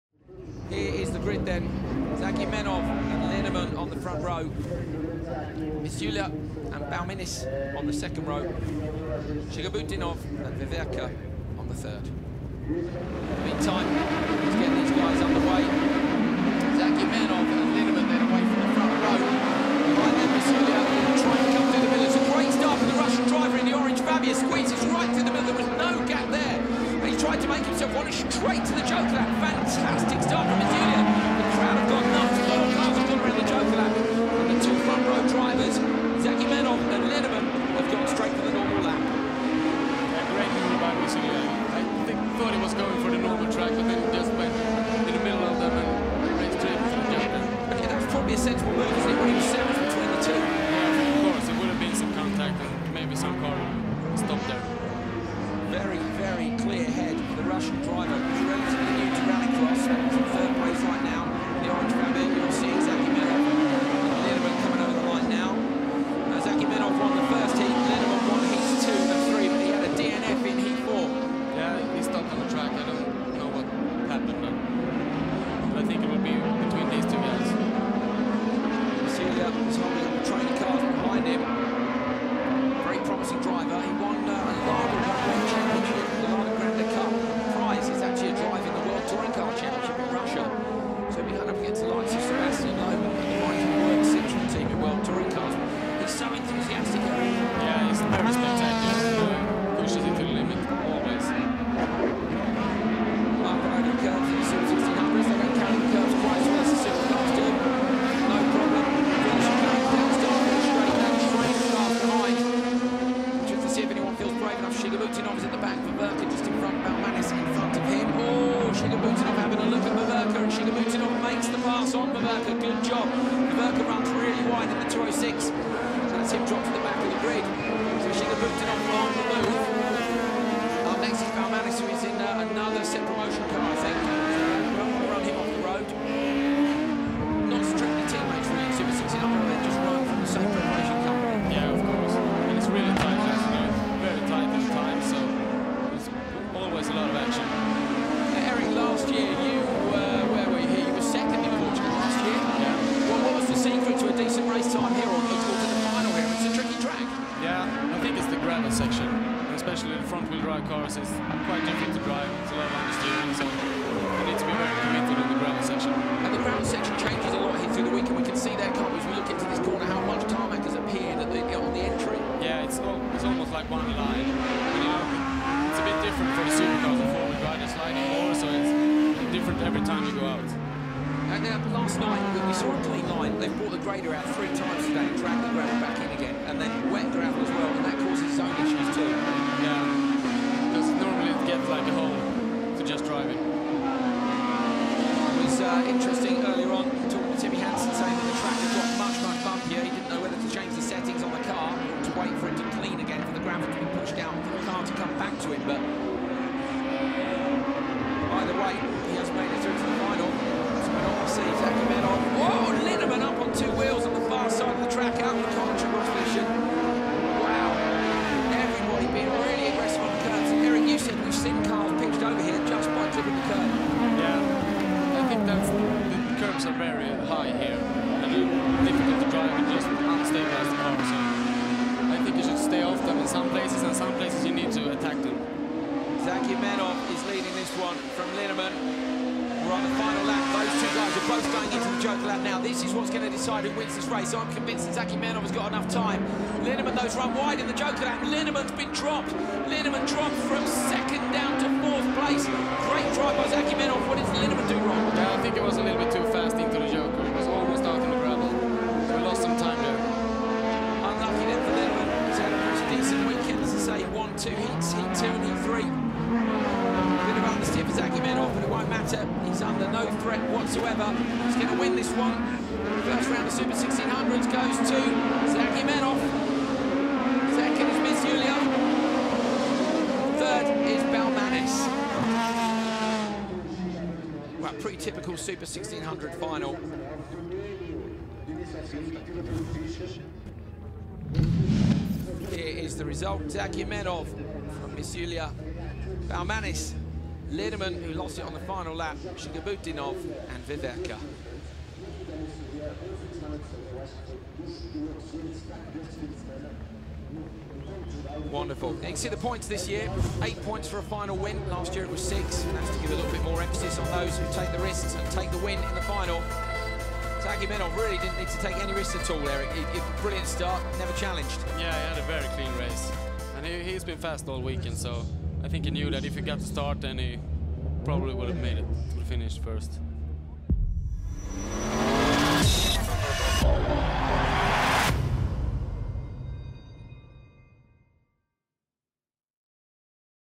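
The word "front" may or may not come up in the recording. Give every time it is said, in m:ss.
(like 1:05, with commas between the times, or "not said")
0:03, 0:18, 2:40.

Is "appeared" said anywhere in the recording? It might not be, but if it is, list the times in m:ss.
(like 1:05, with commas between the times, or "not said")
2:50.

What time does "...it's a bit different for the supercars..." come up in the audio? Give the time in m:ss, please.
2:55.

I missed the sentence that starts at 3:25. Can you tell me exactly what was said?
But either way, he has made it through to the final.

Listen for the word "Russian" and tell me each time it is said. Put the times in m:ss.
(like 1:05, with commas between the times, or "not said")
0:22, 0:57.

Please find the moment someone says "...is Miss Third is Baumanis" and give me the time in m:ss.
4:37.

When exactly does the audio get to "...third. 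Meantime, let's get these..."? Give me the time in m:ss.
0:11.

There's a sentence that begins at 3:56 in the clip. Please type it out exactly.
Zagumennov is leading this one from Linneman.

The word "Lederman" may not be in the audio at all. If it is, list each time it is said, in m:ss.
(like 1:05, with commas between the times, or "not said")
4:57.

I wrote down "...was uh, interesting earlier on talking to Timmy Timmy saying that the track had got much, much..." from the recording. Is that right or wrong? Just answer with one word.
wrong.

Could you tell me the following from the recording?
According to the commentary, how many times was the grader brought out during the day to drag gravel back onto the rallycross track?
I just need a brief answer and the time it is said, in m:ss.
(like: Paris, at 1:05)
3, at 3:04.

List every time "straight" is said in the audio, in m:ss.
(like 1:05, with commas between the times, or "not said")
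0:28, 0:46.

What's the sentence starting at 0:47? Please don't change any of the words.
Okay, that was probably a sensible move because they wanted to sandwich between the two.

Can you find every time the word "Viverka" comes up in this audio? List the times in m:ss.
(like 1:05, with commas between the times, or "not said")
0:10, 5:00.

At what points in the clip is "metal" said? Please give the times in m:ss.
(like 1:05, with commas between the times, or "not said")
not said.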